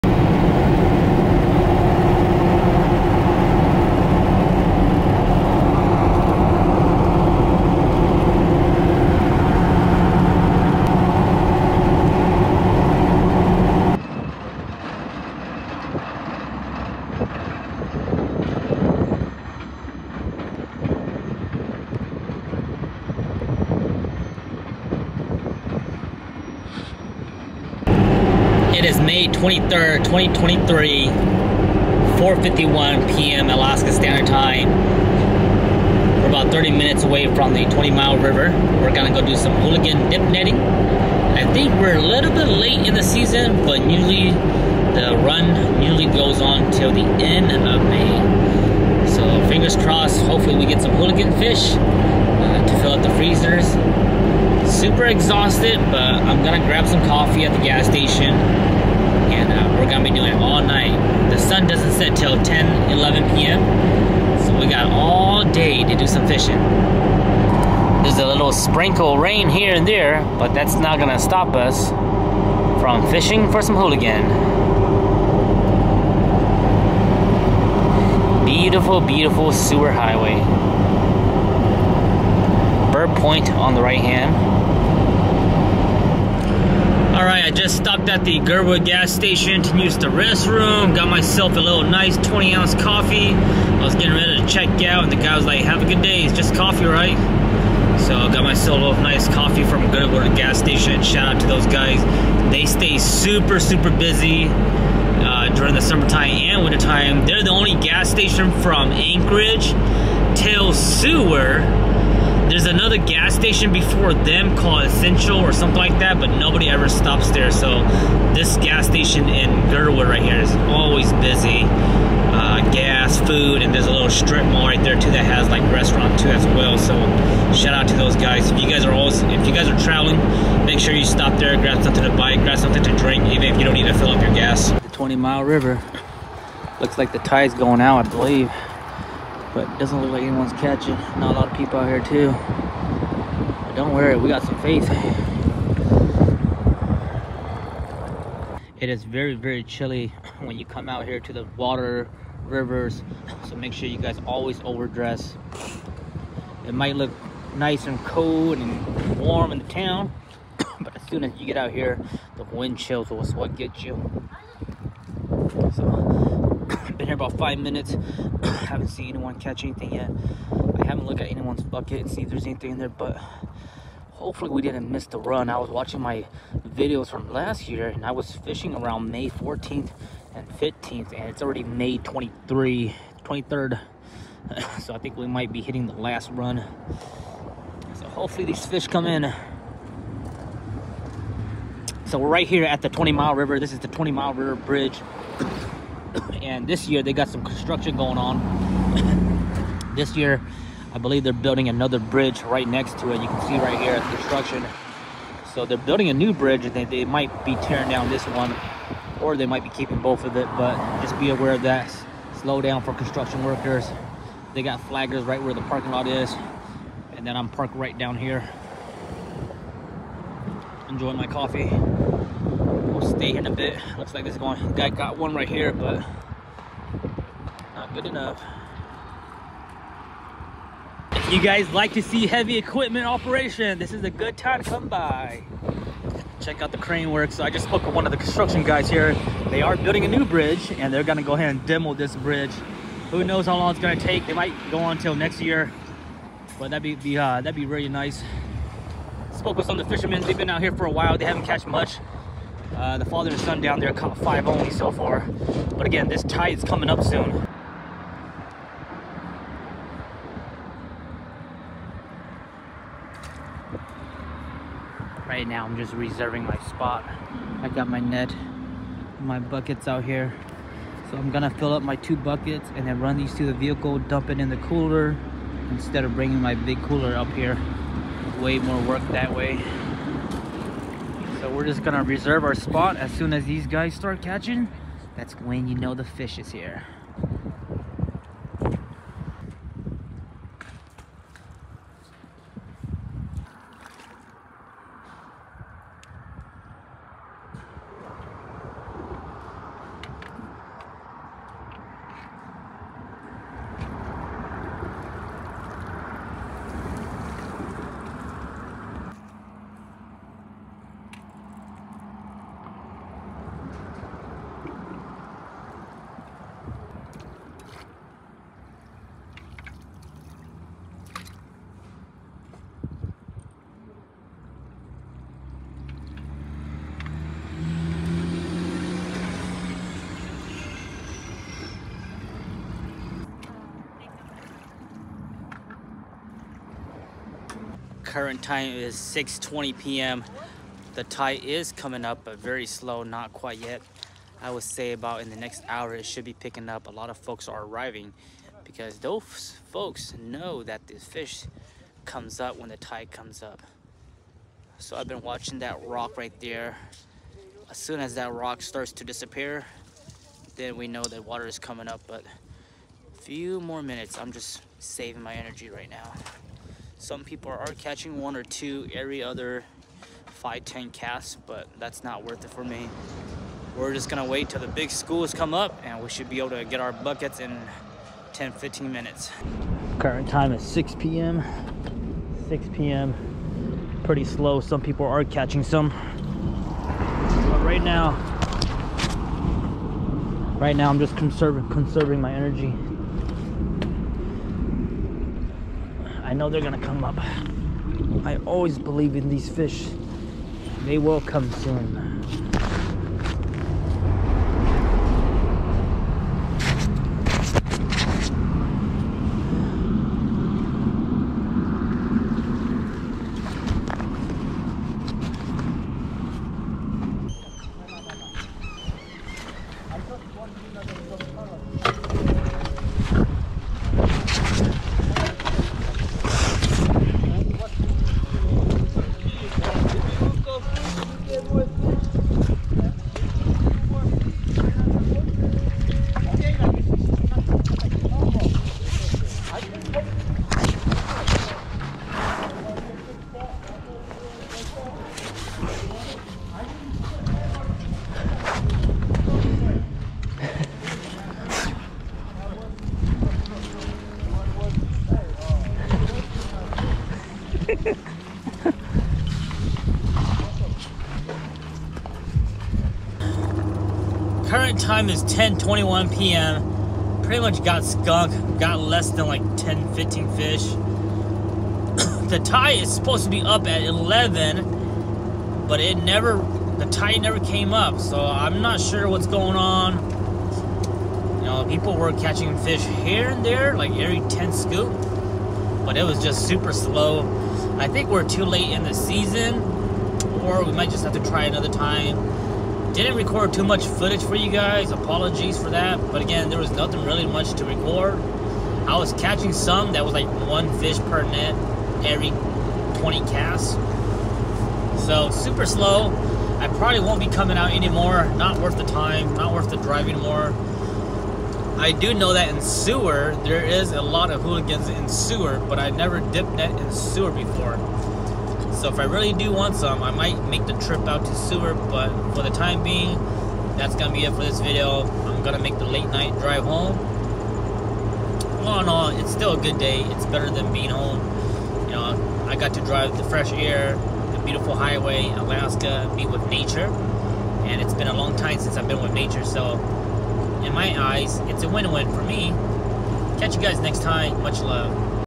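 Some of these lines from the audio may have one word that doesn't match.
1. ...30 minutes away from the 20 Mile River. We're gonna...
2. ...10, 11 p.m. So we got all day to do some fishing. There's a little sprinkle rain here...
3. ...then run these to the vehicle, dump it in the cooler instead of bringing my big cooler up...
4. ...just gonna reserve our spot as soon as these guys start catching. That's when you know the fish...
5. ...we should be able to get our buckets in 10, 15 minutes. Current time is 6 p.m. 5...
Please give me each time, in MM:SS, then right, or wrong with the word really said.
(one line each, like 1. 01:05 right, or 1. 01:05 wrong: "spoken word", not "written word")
1. 00:36 right
2. 01:02 right
3. 04:32 right
4. 04:41 right
5. 06:16 wrong: "6", not "5".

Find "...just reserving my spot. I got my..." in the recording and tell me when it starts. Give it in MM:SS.
04:25.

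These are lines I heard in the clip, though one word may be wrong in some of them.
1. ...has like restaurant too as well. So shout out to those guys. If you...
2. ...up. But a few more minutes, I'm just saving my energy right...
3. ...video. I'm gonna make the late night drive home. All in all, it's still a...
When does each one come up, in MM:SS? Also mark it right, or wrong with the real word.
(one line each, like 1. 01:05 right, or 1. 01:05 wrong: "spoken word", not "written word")
1. 02:05 right
2. 06:01 right
3. 08:44 right.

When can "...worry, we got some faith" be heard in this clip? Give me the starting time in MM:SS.
02:23.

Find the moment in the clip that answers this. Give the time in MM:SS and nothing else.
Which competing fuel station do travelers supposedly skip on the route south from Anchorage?
01:54.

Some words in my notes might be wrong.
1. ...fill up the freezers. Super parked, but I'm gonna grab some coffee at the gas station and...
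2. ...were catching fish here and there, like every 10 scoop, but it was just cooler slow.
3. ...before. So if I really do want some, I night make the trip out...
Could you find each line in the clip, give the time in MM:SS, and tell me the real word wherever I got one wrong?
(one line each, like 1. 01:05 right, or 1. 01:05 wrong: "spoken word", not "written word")
1. 00:52 wrong: "exhausted", not "parked"
2. 08:01 wrong: "super", not "cooler"
3. 08:37 wrong: "might", not "night".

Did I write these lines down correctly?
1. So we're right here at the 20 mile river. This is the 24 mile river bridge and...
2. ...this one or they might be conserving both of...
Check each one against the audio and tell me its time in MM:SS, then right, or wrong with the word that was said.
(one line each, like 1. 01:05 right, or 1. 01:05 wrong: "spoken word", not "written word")
1. 03:12 wrong: "20", not "24"
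2. 03:28 wrong: "keeping", not "conserving".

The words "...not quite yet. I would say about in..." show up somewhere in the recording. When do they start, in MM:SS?
05:43.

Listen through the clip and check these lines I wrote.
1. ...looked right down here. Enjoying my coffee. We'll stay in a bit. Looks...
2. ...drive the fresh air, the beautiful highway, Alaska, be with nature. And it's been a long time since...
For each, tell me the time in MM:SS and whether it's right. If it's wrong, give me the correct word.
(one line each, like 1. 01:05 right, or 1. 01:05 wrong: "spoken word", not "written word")
1. 03:37 wrong: "parked", not "looked"
2. 08:52 right.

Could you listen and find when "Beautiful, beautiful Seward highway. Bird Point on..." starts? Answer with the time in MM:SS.
01:18.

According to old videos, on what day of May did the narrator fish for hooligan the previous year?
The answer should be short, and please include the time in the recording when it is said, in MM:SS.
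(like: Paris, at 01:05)
May 14, at 02:59.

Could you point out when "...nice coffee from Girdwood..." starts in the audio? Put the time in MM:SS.
01:39.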